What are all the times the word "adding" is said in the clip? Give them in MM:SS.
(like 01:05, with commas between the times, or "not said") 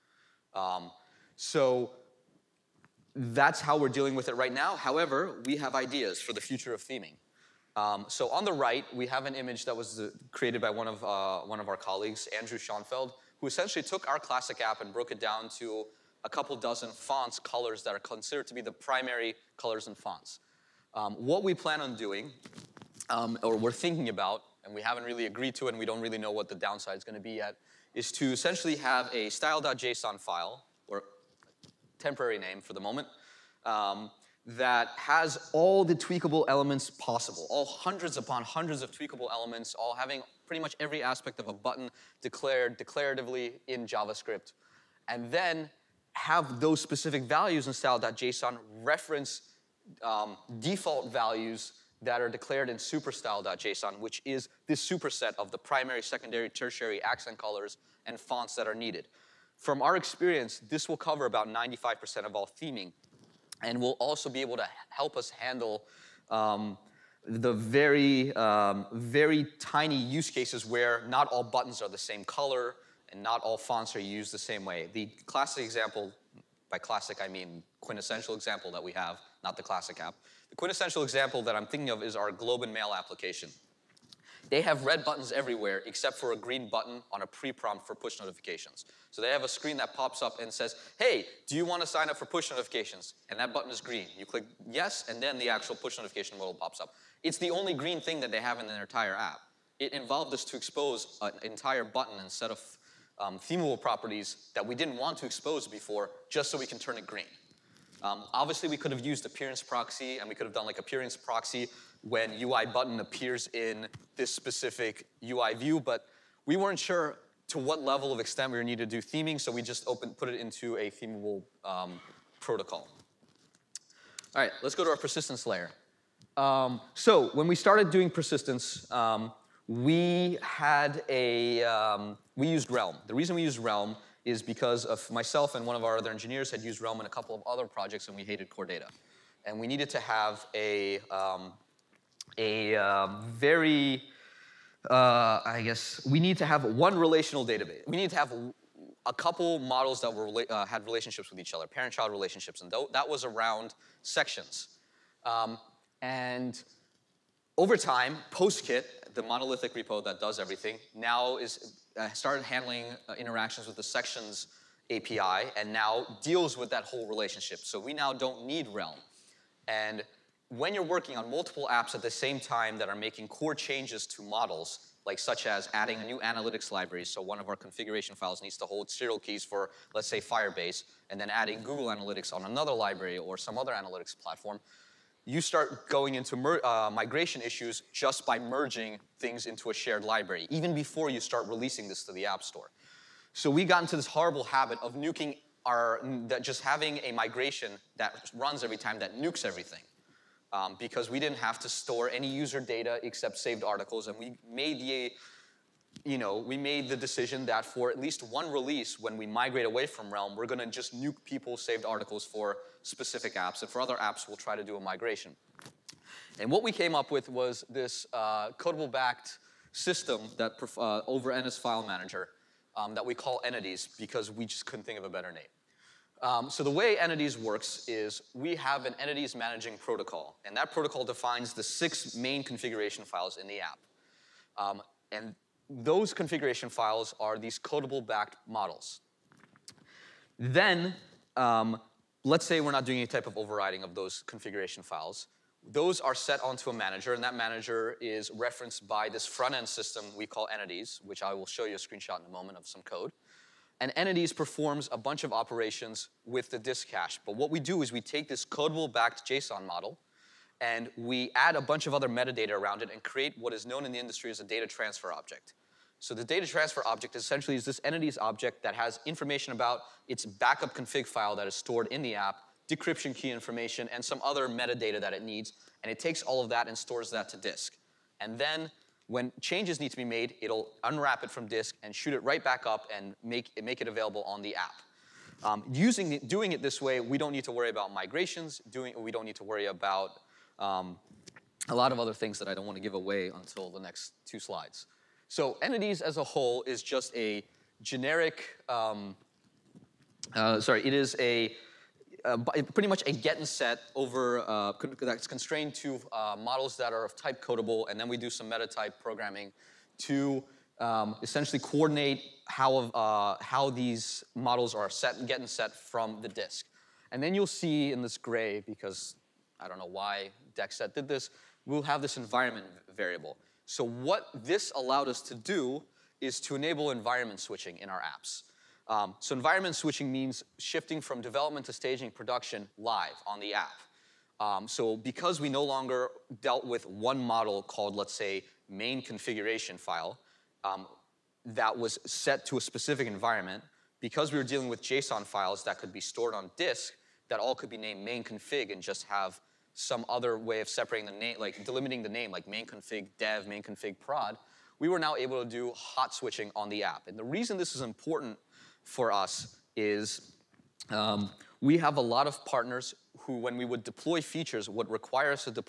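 02:55, 03:01.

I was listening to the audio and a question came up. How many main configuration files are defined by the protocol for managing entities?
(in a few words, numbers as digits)
6.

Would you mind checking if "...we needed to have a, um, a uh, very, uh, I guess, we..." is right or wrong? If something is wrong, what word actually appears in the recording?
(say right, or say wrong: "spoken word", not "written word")
right.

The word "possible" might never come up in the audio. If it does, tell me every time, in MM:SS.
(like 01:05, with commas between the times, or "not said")
00:36.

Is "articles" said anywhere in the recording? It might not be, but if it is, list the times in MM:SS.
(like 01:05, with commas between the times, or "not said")
03:23, 03:31.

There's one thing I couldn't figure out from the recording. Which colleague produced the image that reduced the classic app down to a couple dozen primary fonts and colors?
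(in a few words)
Andrew Schoenfeld.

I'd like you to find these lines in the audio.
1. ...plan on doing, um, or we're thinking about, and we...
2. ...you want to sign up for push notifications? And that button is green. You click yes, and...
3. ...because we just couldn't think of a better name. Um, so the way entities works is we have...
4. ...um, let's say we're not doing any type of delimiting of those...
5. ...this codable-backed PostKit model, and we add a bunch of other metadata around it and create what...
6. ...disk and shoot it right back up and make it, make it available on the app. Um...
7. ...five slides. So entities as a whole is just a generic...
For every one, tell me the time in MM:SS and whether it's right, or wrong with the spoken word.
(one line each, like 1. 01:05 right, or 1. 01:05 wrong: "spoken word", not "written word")
1. 00:21 right
2. 01:31 right
3. 03:43 right
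4. 04:01 wrong: "overriding", not "delimiting"
5. 04:18 wrong: "JSON", not "PostKit"
6. 04:41 right
7. 04:54 wrong: "two", not "five".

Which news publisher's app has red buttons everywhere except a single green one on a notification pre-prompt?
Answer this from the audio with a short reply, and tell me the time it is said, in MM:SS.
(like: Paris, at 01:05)
Globe and Mail, at 01:22.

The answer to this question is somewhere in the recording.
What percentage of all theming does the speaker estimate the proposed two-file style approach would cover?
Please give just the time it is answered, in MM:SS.
01:01.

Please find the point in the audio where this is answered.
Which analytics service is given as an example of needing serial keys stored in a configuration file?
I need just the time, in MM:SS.
03:00.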